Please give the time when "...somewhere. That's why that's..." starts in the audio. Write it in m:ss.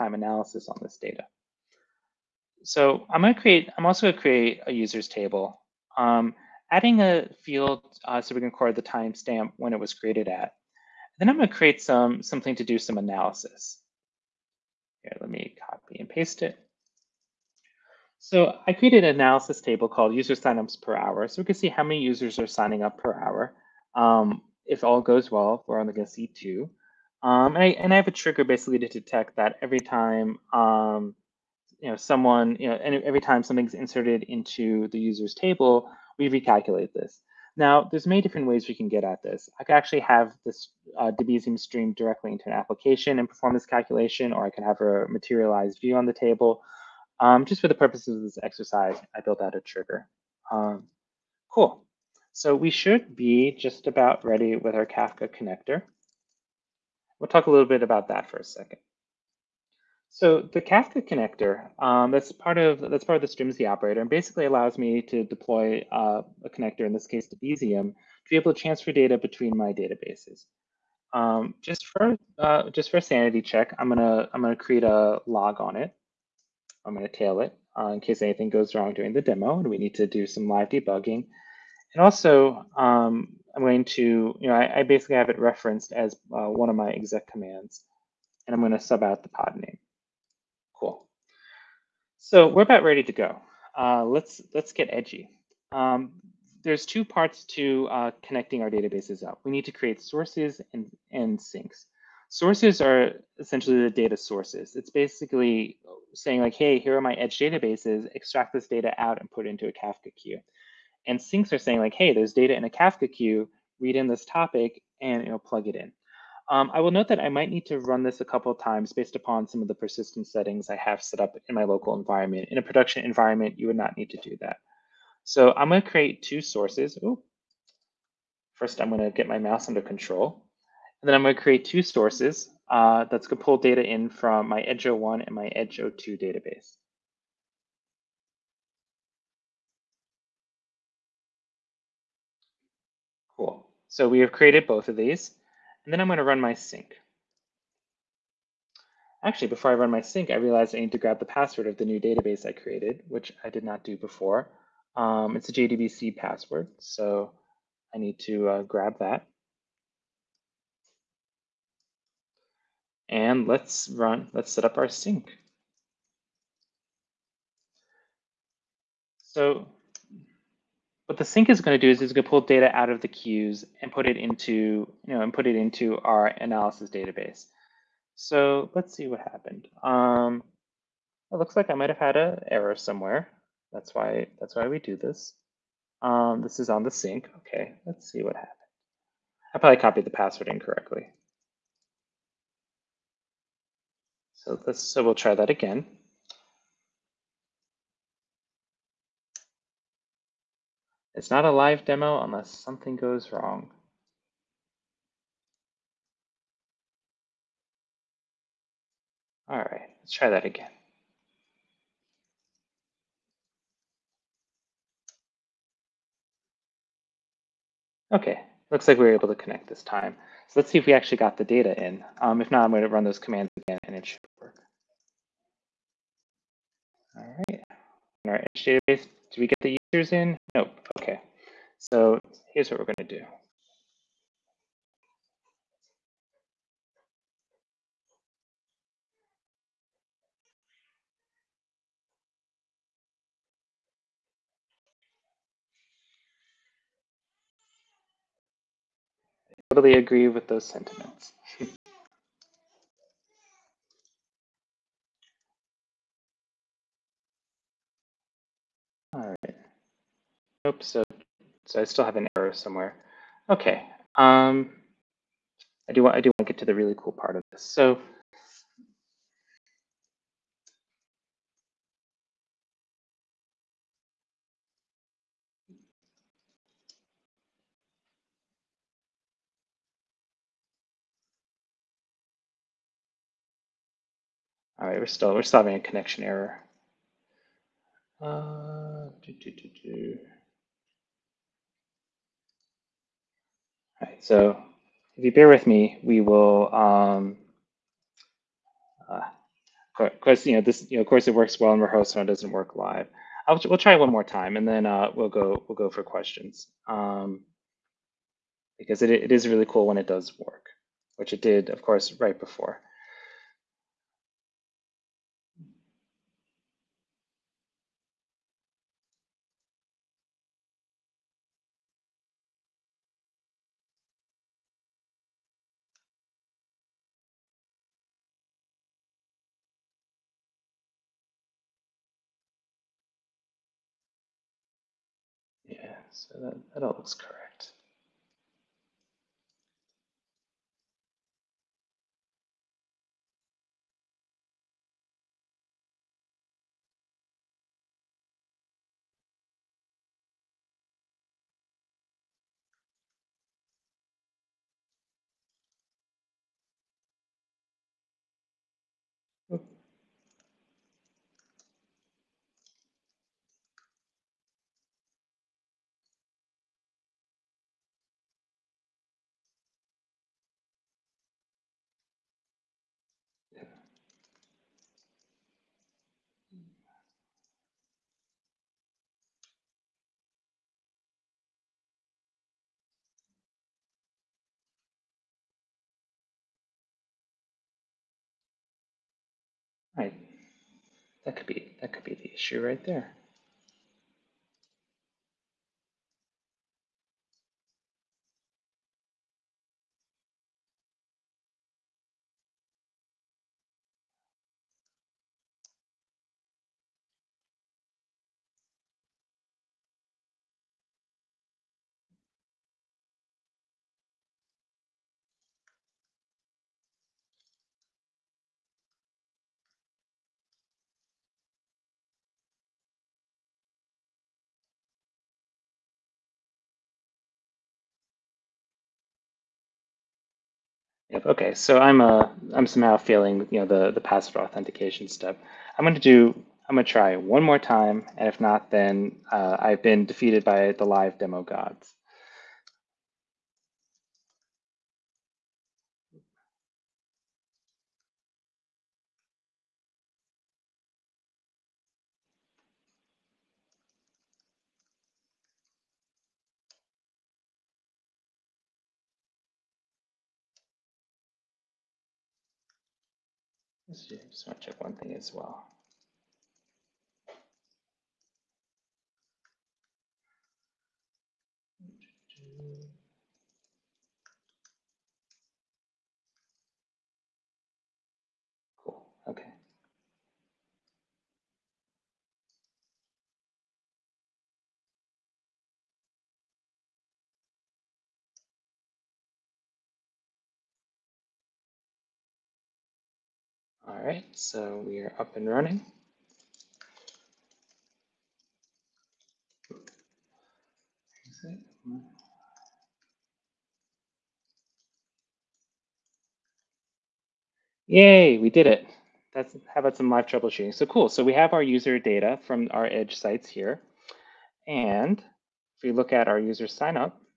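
3:02.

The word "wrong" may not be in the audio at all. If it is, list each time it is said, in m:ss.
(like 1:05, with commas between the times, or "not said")
1:18, 3:23.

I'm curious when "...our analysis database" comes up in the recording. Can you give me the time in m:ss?
2:55.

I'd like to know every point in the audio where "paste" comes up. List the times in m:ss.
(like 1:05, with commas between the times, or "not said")
0:16.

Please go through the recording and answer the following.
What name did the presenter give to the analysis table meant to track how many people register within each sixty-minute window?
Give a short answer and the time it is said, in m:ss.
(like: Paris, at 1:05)
user signups per hour, at 0:20.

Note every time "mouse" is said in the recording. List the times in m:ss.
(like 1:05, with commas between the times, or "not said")
2:09.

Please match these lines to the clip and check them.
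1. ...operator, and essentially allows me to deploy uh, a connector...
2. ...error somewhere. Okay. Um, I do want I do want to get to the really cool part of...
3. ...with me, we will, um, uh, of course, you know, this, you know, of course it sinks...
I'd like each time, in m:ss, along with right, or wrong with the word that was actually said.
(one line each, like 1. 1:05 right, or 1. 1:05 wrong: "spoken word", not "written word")
1. 1:03 wrong: "basically", not "essentially"
2. 4:22 right
3. 4:55 wrong: "works", not "sinks".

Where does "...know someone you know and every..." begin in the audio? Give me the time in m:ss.
0:31.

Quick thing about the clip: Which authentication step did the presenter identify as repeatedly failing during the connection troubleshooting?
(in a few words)
password authentication.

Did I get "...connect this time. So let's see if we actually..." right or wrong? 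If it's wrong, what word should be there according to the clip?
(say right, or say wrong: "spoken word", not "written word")
right.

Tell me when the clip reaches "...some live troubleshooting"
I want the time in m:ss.
8:29.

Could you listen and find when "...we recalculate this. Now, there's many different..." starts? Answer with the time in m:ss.
0:36.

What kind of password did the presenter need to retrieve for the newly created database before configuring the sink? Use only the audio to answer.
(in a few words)
JDBC password.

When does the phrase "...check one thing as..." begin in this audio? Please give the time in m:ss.
7:44.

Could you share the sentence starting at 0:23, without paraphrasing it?
Um, if all goes well, we're only going to see two.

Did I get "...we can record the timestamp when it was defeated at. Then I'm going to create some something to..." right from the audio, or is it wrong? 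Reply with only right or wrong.
wrong.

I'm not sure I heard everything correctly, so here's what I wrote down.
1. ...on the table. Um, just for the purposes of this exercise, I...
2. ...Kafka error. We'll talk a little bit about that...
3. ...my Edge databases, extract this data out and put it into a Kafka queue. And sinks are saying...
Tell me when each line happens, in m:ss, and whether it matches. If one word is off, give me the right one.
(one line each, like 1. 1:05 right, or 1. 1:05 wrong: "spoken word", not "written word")
1. 0:45 right
2. 0:54 wrong: "connector", not "error"
3. 1:47 right.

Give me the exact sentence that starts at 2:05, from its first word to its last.
So I'm gonna create two sources.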